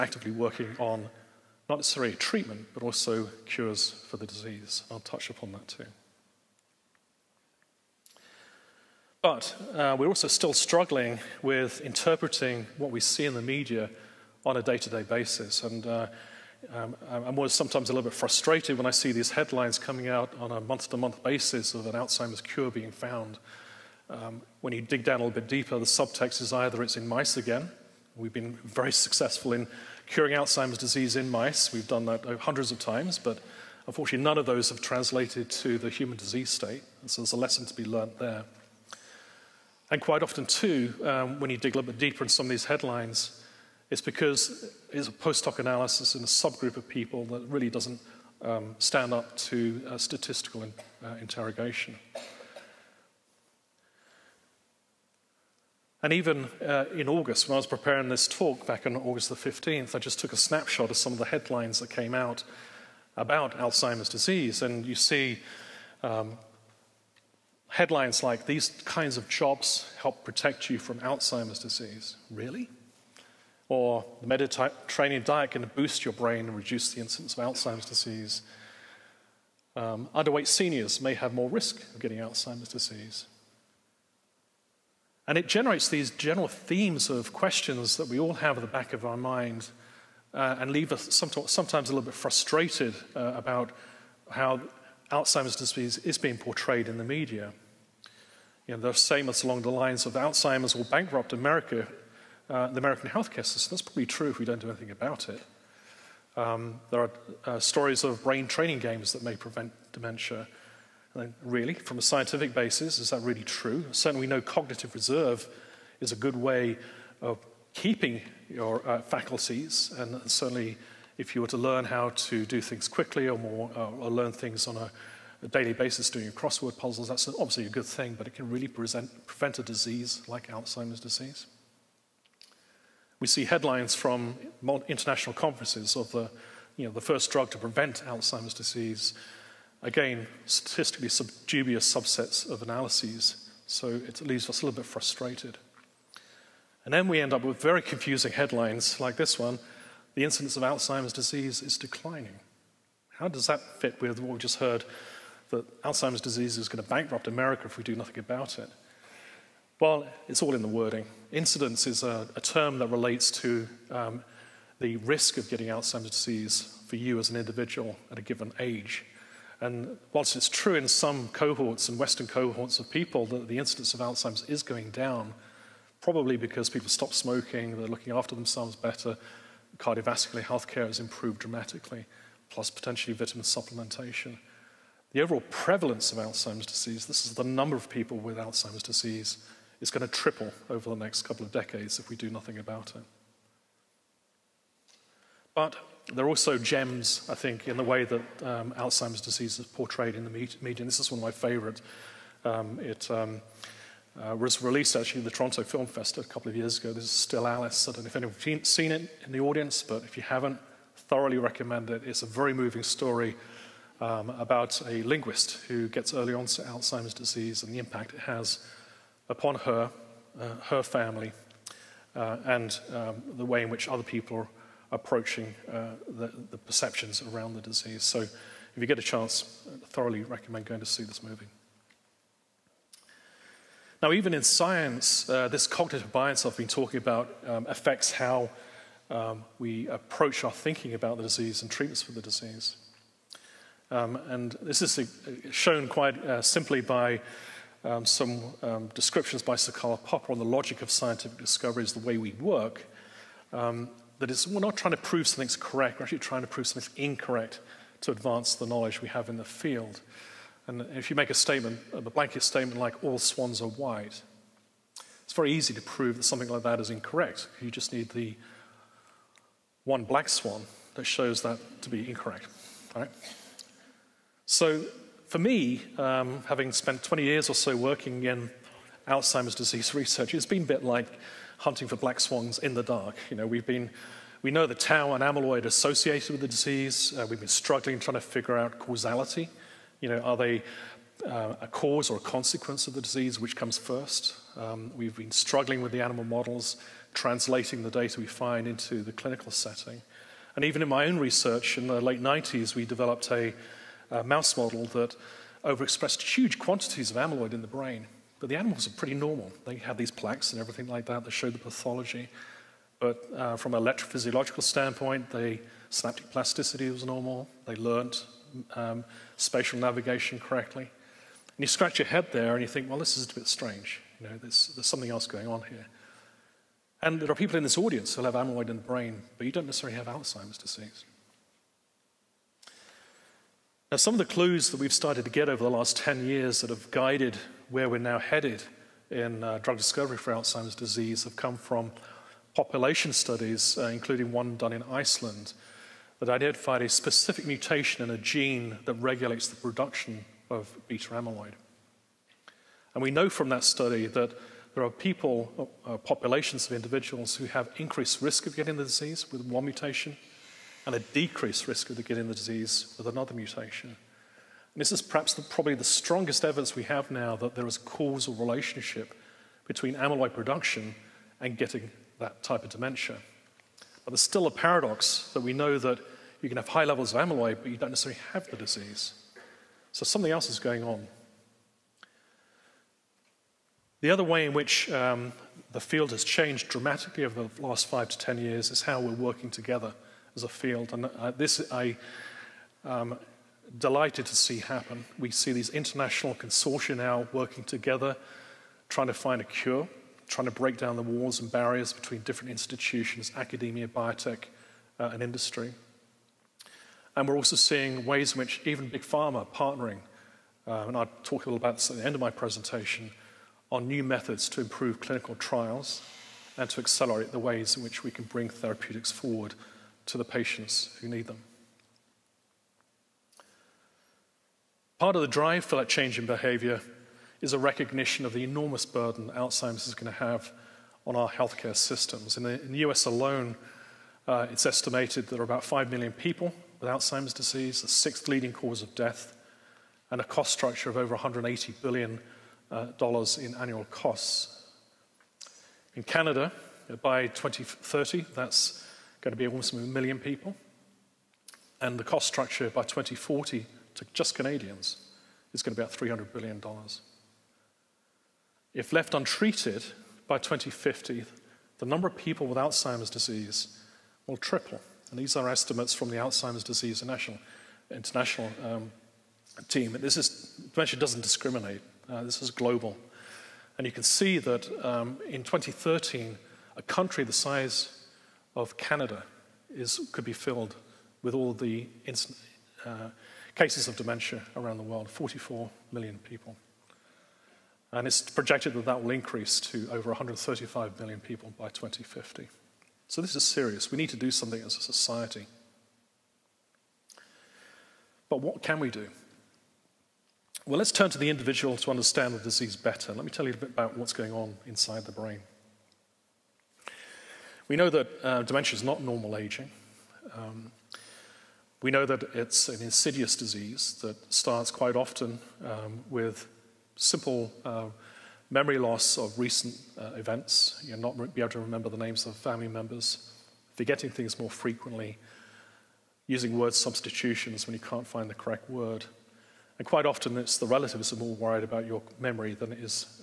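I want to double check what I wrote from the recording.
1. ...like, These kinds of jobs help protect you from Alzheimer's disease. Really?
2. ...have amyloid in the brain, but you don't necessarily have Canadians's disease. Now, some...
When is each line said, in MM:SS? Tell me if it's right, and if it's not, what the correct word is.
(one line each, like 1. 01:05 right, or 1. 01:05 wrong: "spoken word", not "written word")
1. 01:08 right
2. 05:28 wrong: "Alzheimer", not "Canadians".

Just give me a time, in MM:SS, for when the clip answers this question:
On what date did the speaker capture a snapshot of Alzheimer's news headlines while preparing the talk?
00:58.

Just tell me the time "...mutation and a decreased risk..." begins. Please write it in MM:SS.
05:59.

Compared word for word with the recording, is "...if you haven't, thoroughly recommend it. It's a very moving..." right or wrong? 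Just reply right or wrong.
right.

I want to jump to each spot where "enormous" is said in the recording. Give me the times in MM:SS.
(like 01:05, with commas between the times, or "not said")
07:08.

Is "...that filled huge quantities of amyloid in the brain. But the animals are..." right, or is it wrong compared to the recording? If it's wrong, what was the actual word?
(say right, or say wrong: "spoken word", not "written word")
wrong: "overexpressed", not "filled".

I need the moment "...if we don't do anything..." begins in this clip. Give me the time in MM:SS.
01:44.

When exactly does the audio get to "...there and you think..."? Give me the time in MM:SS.
05:22.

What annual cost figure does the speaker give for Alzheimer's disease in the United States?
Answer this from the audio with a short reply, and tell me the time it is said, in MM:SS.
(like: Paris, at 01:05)
Over $180 billion, at 07:20.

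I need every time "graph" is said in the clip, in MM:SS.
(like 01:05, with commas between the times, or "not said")
not said.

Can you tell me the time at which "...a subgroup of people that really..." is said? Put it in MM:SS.
00:46.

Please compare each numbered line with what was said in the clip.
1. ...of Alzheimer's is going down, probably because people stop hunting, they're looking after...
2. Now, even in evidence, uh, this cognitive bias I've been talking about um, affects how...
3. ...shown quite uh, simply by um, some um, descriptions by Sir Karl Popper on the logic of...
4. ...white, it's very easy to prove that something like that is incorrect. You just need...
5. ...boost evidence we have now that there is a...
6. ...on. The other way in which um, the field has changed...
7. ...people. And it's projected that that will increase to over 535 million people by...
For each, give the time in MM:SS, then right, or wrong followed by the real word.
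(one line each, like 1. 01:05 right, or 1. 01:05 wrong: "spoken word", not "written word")
1. 02:53 wrong: "smoking", not "hunting"
2. 03:54 wrong: "science", not "evidence"
3. 04:05 right
4. 04:23 right
5. 06:05 wrong: "strongest", not "boost"
6. 06:20 right
7. 08:06 wrong: "135", not "535".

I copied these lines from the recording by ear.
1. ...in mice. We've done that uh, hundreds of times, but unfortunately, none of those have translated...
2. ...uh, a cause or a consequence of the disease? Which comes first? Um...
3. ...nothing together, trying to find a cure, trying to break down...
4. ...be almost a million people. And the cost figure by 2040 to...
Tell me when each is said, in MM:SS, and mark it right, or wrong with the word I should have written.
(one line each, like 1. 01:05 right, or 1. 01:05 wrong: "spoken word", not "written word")
1. 00:31 right
2. 04:51 right
3. 06:37 wrong: "working", not "nothing"
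4. 07:29 wrong: "structure", not "figure".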